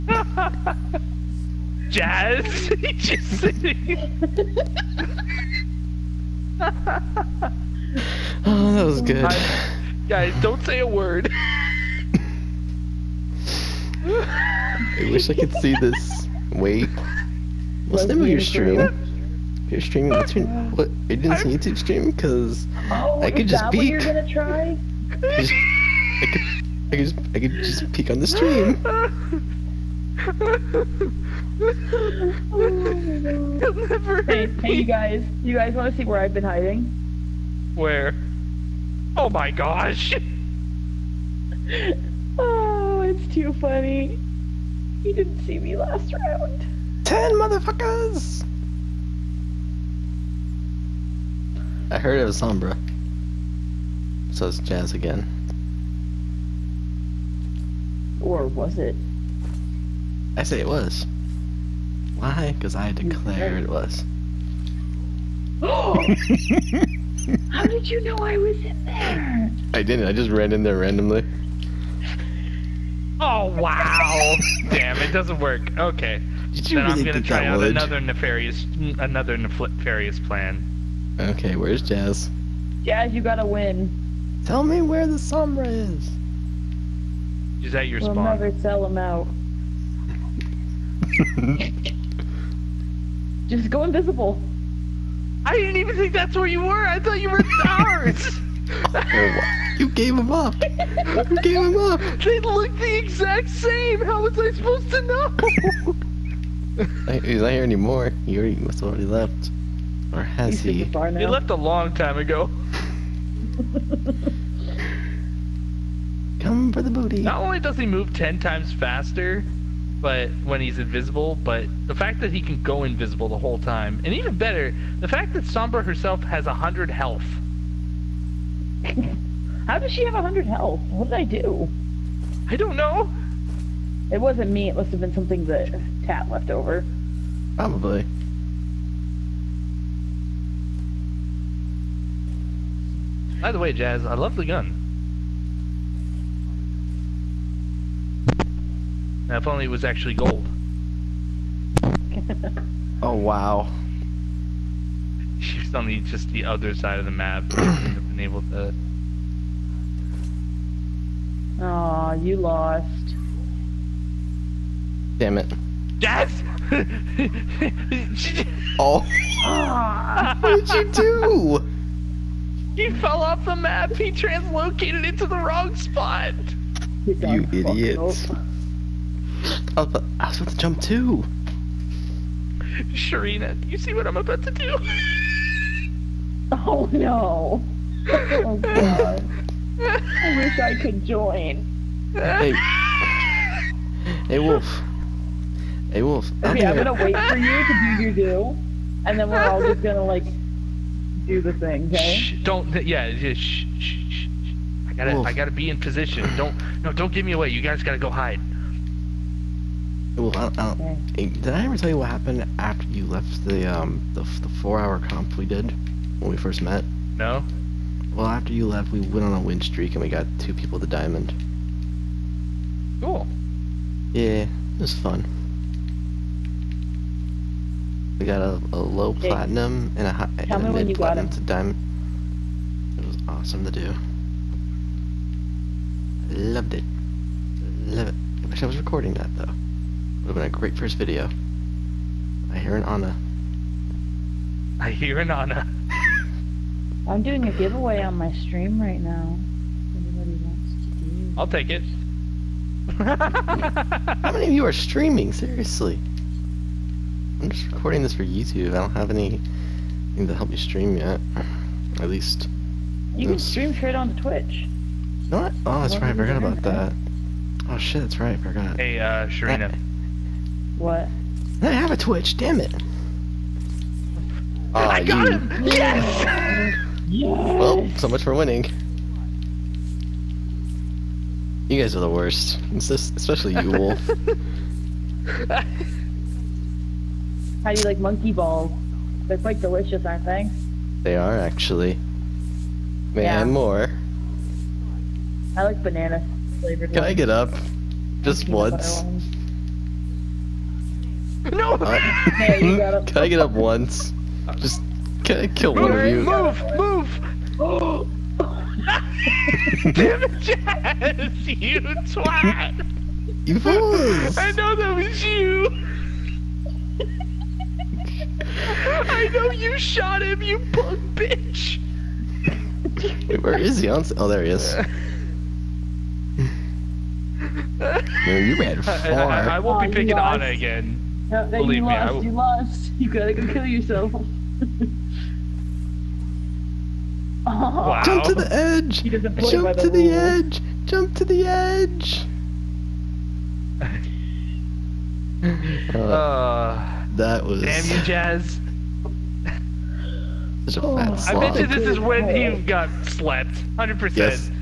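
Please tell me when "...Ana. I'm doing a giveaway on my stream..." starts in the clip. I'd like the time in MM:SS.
04:05.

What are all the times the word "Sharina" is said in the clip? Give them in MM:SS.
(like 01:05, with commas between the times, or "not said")
03:02, 04:29.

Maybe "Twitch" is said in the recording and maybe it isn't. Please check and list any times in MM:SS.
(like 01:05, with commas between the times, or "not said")
04:24, 04:31.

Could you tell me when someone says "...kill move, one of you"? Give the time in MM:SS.
05:05.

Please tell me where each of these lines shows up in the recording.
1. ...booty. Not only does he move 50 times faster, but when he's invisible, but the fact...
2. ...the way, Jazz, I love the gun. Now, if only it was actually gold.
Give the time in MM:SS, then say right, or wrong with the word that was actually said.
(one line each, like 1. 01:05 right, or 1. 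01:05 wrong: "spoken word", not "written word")
1. 01:56 wrong: "10", not "50"
2. 02:23 right.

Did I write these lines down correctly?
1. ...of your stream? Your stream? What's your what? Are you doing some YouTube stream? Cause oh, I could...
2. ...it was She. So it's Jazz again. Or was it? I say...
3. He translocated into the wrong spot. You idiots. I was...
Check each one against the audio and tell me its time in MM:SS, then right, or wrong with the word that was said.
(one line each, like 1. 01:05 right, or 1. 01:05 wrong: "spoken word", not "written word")
1. 00:18 right
2. 00:52 wrong: "Sombra", not "She"
3. 02:53 right.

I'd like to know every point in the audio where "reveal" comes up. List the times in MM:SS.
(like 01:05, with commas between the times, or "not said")
not said.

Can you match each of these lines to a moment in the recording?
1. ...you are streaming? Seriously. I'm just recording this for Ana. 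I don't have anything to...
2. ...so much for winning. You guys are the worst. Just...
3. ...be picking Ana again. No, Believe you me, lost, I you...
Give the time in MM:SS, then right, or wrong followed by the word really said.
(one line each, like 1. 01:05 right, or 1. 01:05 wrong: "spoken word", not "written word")
1. 04:14 wrong: "YouTube", not "Ana"
2. 04:37 right
3. 05:29 right.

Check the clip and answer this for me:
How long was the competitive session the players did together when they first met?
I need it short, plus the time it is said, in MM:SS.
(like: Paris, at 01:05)
4 hours, at 03:34.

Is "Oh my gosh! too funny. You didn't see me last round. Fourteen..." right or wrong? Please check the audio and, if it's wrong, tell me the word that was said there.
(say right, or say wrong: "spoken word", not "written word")
wrong: "Ten", not "Fourteen".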